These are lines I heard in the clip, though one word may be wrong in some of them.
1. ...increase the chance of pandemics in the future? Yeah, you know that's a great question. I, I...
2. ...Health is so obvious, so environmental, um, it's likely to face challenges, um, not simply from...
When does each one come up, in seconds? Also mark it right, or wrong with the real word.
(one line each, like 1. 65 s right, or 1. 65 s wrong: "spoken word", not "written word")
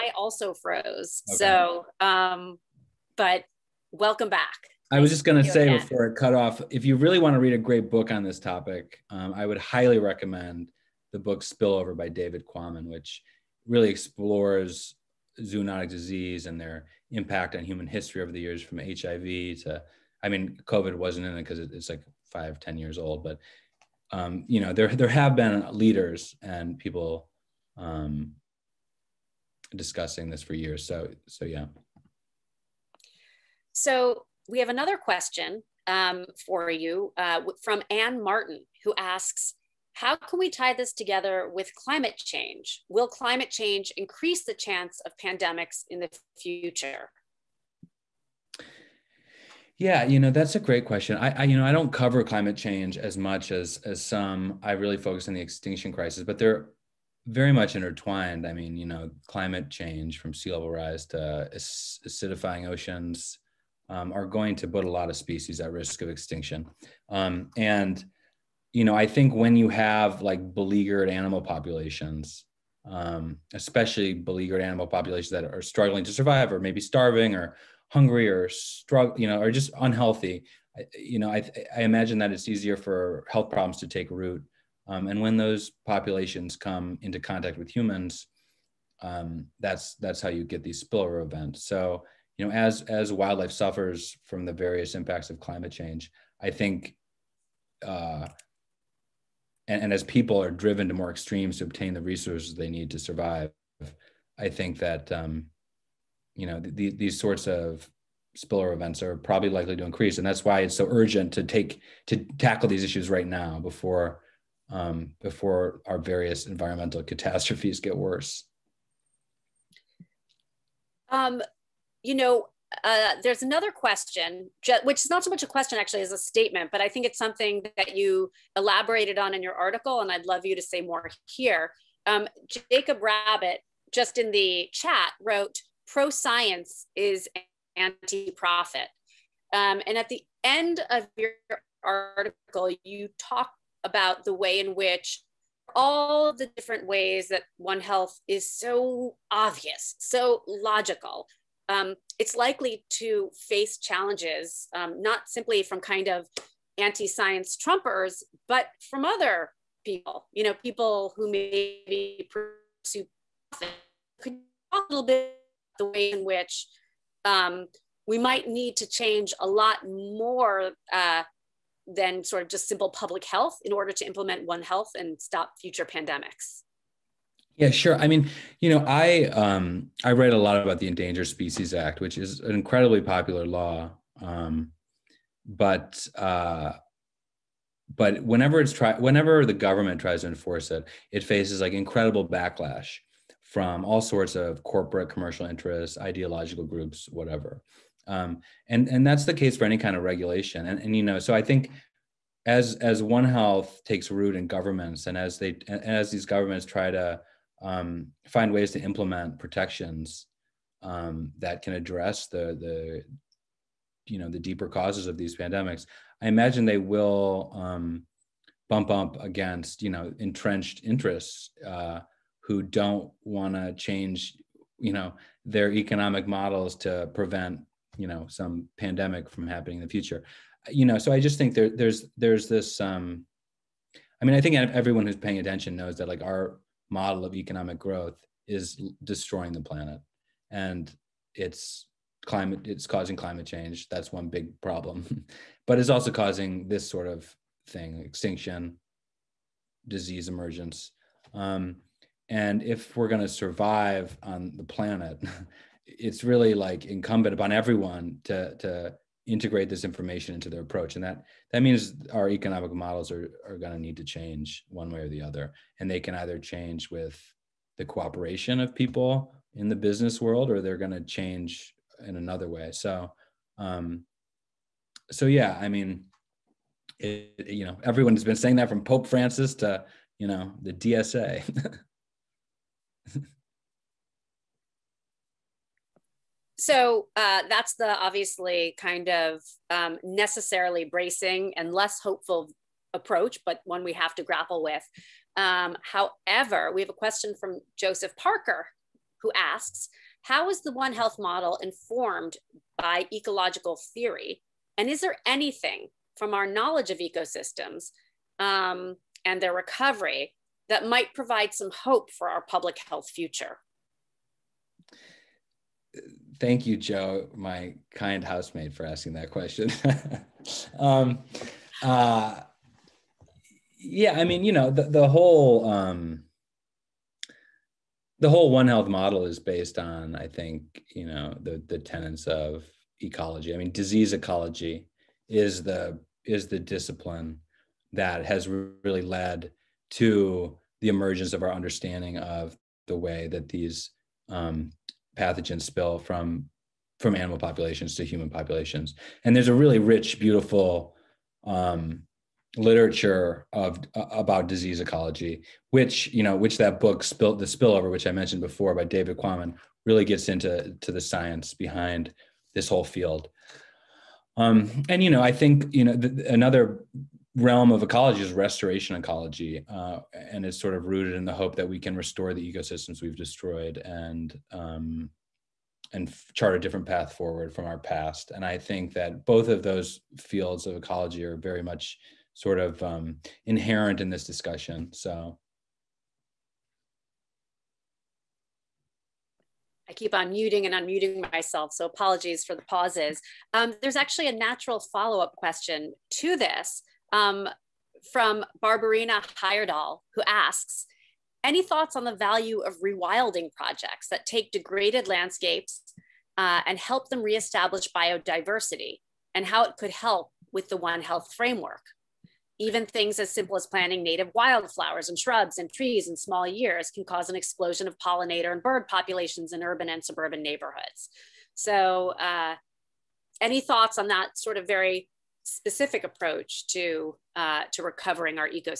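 1. 43 s right
2. 147 s wrong: "logical", not "environmental".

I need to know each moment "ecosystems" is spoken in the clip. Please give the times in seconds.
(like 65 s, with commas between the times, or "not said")
306 s, 372 s.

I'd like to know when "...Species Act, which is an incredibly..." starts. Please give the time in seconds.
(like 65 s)
181 s.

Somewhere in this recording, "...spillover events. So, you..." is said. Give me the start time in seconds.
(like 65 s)
90 s.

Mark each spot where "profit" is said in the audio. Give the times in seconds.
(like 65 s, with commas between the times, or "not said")
138 s, 163 s.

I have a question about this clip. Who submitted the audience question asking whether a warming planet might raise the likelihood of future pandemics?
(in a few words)
Anne Martin.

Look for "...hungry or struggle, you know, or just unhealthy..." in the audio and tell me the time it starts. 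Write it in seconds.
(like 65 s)
77 s.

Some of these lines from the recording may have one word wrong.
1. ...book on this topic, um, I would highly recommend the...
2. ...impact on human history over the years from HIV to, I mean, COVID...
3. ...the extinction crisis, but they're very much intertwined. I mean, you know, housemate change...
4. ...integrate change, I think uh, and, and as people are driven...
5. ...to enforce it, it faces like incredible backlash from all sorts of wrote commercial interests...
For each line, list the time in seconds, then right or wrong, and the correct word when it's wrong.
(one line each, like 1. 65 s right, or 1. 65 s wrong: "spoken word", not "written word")
1. 7 s right
2. 17 s right
3. 55 s wrong: "climate", not "housemate"
4. 95 s wrong: "climate", not "integrate"
5. 190 s wrong: "corporate", not "wrote".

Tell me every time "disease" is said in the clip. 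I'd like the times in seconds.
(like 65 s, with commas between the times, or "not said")
15 s, 249 s, 333 s, 354 s.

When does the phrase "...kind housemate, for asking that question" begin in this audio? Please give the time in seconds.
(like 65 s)
317 s.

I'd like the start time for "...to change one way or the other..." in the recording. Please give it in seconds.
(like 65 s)
263 s.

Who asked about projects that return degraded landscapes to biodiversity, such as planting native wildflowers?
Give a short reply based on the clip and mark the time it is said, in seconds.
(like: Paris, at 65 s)
Barbarina Heyerdahl, at 398 s.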